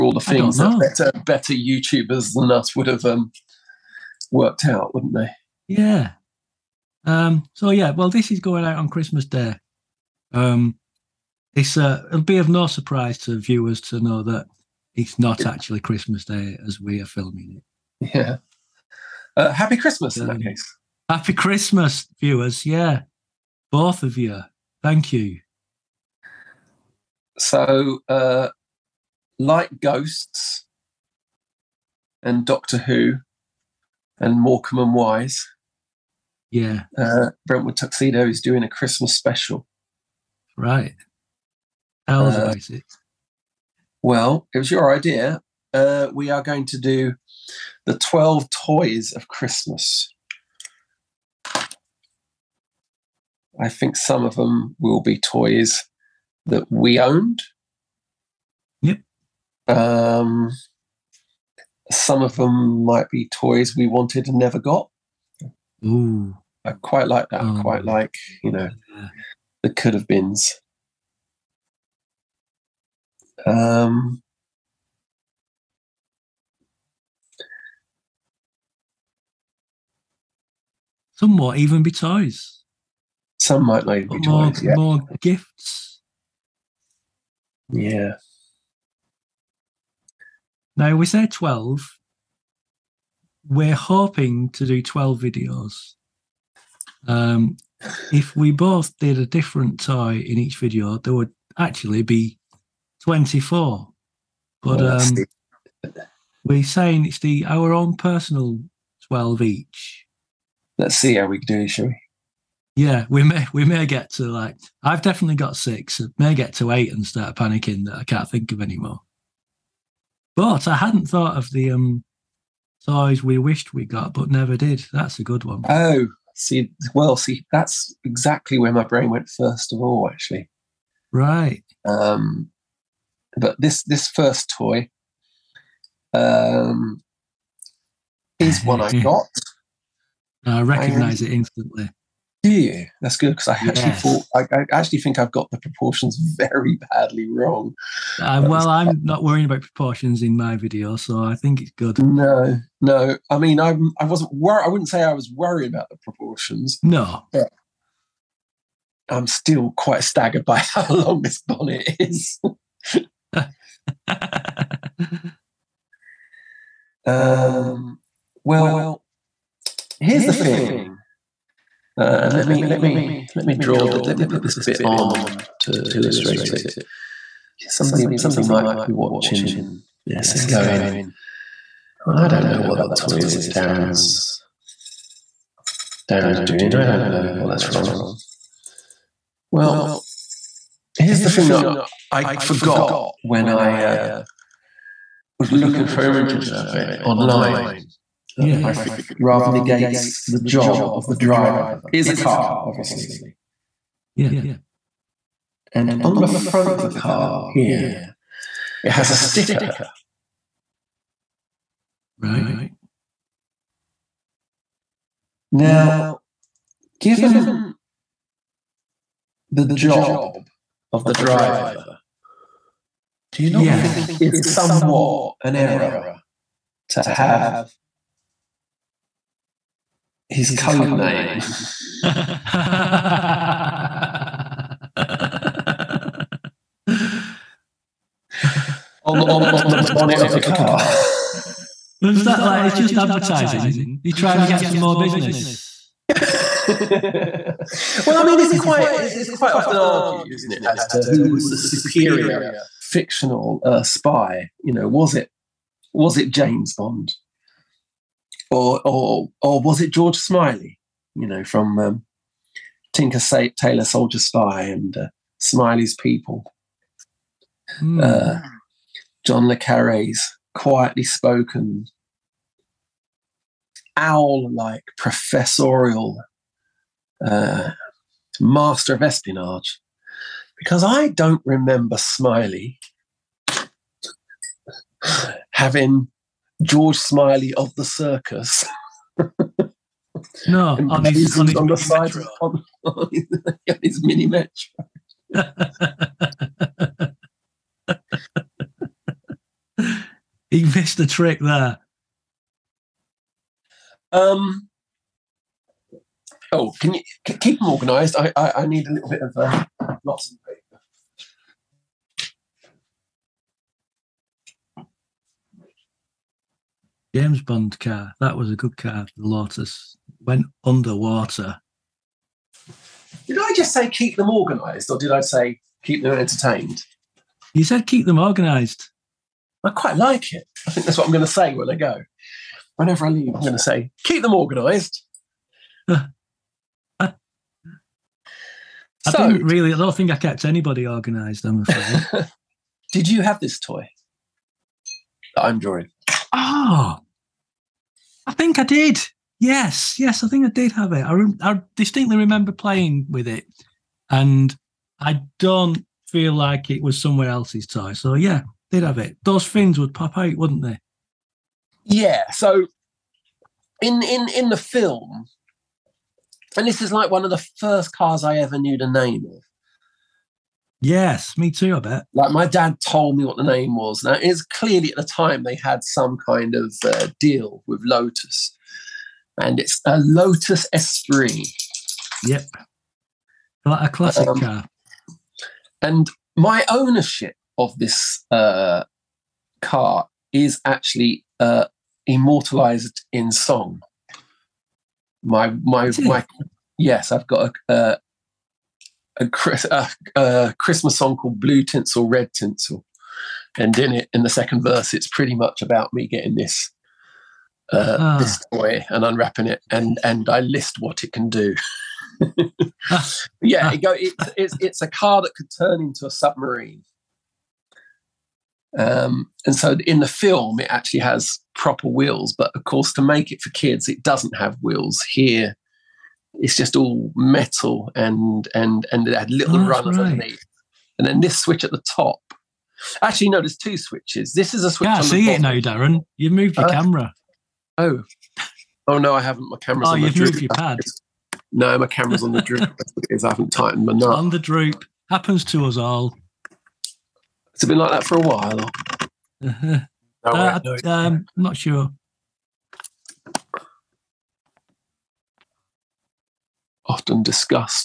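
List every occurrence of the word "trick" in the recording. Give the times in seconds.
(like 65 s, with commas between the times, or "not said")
301 s.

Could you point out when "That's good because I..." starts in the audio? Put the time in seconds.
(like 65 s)
143 s.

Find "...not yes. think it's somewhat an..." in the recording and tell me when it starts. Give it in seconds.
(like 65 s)
223 s.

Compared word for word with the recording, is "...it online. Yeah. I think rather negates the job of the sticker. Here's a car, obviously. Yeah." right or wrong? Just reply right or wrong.
wrong.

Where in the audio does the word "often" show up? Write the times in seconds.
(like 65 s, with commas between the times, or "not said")
249 s, 456 s.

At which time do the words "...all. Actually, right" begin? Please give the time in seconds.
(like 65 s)
129 s.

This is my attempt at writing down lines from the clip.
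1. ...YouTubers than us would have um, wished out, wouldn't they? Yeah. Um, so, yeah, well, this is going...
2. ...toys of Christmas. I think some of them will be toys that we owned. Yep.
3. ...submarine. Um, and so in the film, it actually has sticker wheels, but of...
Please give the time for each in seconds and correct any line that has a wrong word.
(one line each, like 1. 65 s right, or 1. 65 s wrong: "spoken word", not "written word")
1. 1 s wrong: "worked", not "wished"
2. 48 s right
3. 416 s wrong: "proper", not "sticker".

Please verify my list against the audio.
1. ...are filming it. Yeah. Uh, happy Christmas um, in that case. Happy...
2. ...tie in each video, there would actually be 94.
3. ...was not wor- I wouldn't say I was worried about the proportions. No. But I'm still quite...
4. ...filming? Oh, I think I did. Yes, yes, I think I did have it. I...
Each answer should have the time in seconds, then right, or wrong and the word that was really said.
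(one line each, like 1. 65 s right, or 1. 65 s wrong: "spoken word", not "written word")
1. 17 s right
2. 99 s wrong: "24", not "94"
3. 154 s right
4. 345 s wrong: "drawing", not "filming".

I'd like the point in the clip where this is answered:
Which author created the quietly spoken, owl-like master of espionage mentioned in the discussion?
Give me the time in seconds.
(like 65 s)
269 s.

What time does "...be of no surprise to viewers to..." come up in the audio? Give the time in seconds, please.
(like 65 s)
12 s.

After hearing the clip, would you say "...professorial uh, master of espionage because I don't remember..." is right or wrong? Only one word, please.
right.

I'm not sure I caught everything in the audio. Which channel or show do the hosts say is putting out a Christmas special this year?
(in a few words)
Brentwood Tuxedo.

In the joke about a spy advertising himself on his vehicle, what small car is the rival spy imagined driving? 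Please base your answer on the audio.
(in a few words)
Mini Metro.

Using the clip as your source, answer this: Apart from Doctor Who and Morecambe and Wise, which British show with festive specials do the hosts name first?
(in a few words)
Ghosts.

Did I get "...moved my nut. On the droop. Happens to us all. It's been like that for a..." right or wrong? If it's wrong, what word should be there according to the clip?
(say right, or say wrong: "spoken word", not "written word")
wrong: "tightened", not "moved".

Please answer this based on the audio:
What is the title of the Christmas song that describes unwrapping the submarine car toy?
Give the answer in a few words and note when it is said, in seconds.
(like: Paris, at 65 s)
Blue Tinsel, Red Tinsel, at 401 s.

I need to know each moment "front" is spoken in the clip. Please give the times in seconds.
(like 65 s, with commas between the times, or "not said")
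206 s.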